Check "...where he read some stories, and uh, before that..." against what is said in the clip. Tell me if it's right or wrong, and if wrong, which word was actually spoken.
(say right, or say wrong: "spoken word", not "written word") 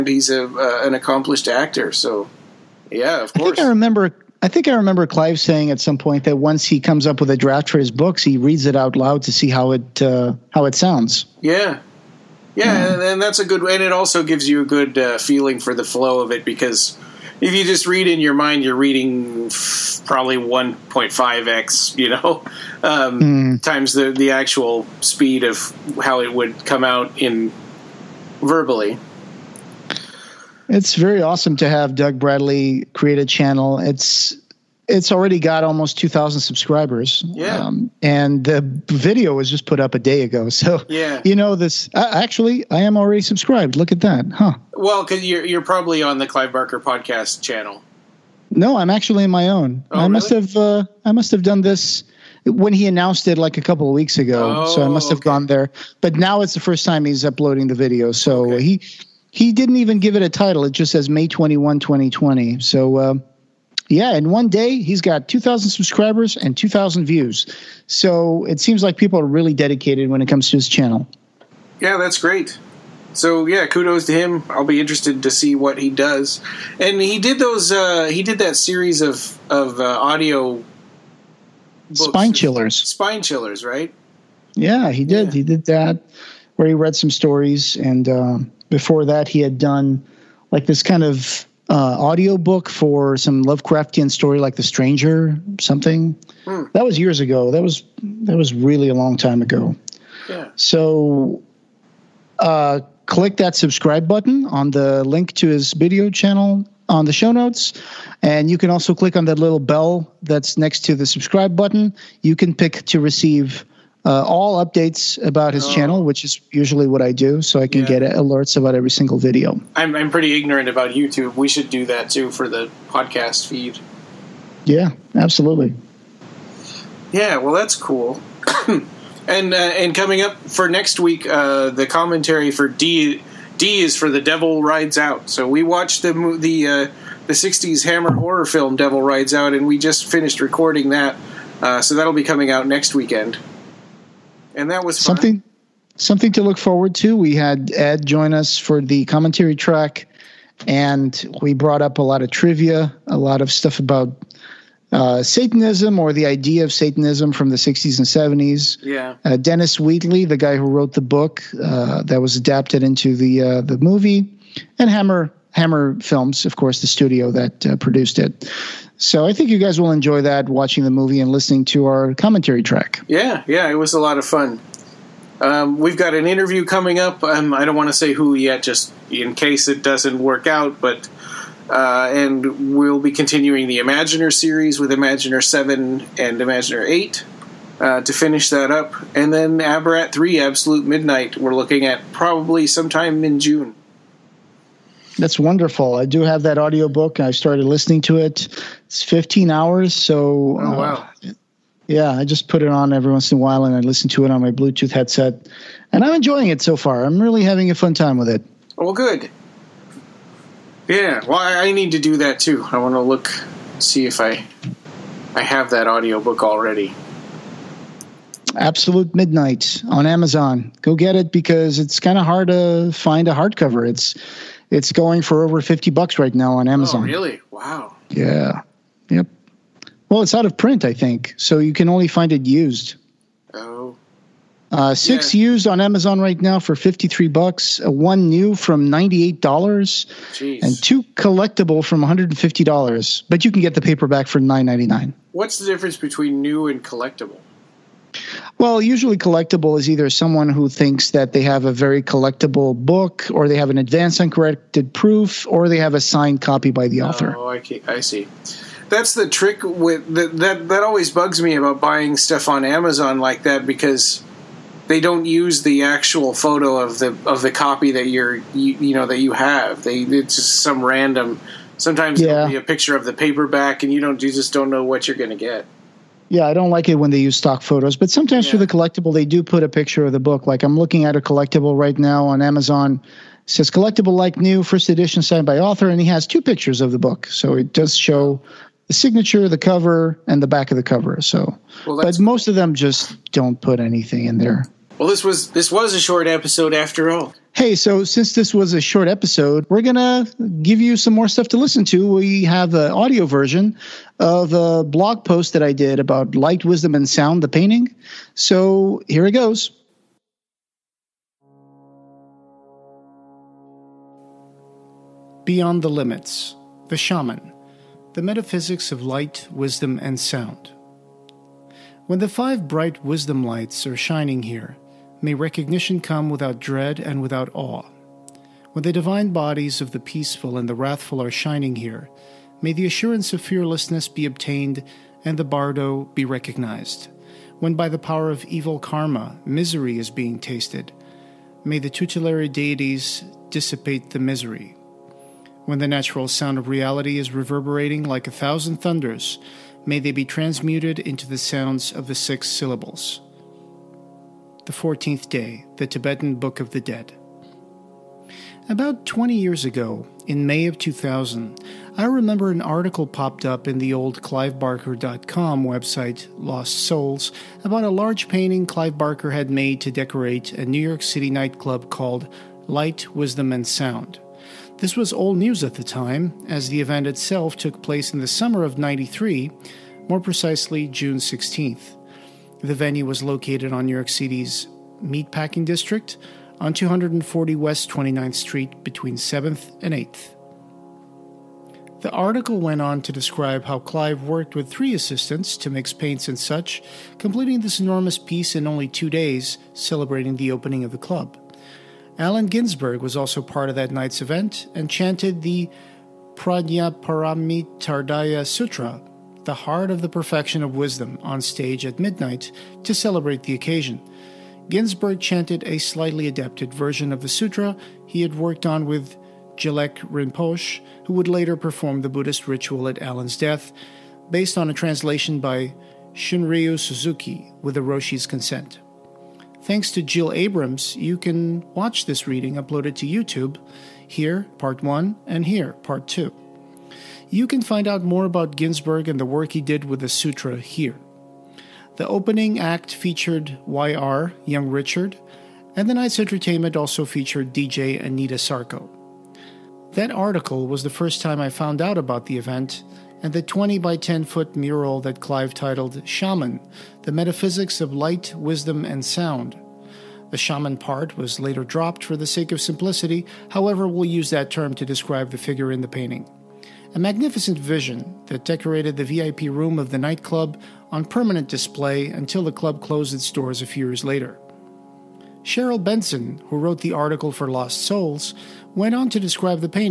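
right.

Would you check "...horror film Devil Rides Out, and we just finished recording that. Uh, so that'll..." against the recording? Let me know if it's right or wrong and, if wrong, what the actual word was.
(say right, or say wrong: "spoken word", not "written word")
right.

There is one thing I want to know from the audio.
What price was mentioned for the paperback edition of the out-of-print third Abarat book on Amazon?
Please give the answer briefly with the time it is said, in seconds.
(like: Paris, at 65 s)
$9.99, at 244 s.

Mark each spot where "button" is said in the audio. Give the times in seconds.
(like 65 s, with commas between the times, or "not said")
104 s, 111 s.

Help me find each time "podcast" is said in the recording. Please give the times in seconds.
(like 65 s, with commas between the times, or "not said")
46 s, 122 s.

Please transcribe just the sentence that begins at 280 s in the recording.
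Like I'm looking at a collectible right now on Amazon.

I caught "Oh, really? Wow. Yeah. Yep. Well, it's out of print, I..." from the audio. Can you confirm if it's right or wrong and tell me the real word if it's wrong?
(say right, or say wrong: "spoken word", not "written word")
right.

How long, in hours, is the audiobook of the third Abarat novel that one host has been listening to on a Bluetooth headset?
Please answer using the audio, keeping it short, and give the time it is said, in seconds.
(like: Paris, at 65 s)
15 hours, at 198 s.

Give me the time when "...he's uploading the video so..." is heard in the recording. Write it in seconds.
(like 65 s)
57 s.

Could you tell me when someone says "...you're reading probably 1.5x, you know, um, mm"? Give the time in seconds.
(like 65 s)
18 s.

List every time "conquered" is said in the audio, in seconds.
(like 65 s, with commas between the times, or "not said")
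not said.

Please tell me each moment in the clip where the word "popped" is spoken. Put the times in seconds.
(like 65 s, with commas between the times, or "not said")
363 s.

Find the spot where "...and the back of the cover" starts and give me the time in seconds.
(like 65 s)
290 s.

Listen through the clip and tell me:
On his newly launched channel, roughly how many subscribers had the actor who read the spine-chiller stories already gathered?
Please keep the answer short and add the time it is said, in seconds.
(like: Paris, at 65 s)
2000, at 35 s.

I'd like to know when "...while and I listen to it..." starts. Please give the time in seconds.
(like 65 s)
203 s.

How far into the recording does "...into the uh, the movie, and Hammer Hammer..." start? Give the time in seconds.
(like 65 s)
162 s.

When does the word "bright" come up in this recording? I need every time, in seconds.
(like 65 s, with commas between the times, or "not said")
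322 s.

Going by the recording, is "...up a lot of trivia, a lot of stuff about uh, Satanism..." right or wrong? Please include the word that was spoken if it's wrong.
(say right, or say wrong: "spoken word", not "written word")
right.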